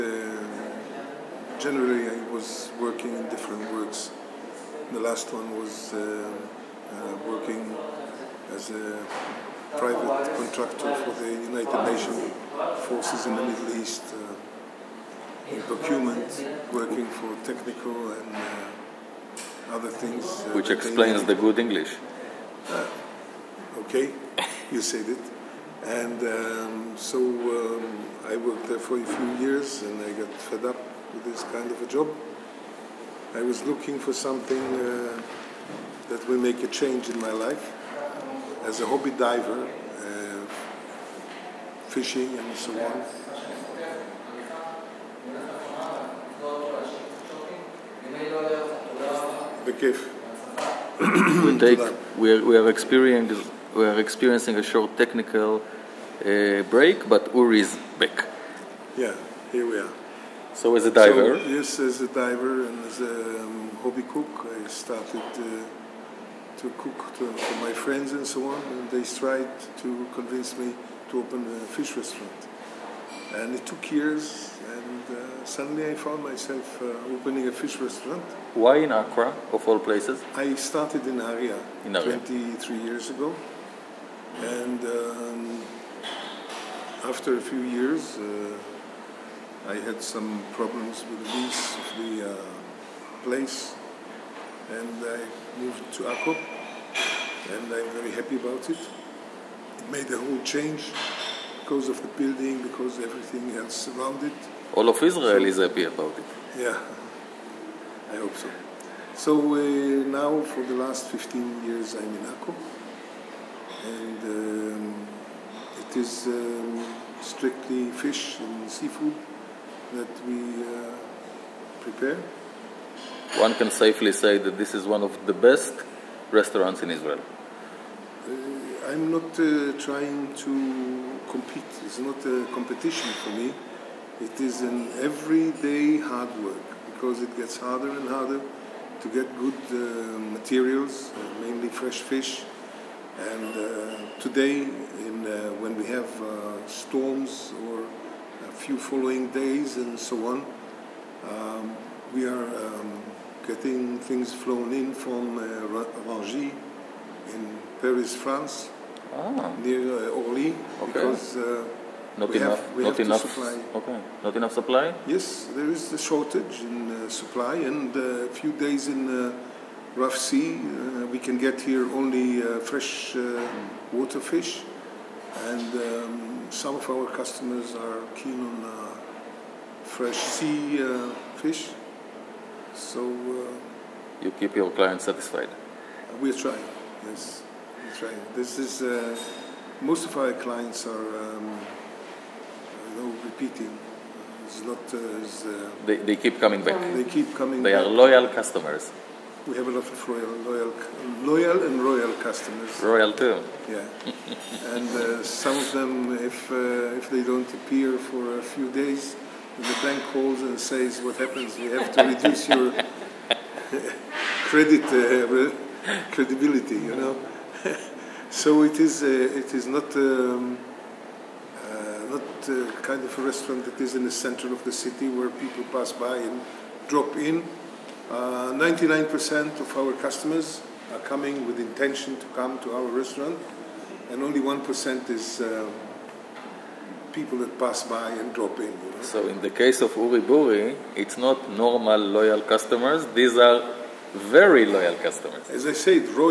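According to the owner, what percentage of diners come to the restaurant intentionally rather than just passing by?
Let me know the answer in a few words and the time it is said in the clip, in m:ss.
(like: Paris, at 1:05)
99%, at 3:48.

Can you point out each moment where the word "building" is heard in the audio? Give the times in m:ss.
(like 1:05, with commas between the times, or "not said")
1:42.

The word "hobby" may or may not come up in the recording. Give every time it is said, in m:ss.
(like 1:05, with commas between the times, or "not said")
0:38, 1:03.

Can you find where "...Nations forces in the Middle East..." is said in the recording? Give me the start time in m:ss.
0:11.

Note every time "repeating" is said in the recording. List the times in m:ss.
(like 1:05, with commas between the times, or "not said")
3:13.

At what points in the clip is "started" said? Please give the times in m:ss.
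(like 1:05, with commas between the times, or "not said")
1:04, 1:20.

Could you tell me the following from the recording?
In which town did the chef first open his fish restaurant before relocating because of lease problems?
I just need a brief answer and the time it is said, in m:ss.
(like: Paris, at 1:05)
Nahariya, at 1:21.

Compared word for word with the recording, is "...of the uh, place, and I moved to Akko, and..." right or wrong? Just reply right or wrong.
wrong.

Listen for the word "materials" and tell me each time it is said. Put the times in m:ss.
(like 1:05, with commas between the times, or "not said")
2:20.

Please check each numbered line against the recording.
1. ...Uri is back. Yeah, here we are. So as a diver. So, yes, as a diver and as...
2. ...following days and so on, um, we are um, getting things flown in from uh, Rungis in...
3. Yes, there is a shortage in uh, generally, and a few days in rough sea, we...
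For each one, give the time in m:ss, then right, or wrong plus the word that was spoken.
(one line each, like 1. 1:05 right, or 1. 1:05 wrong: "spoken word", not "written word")
1. 0:57 right
2. 2:28 right
3. 2:45 wrong: "supply", not "generally".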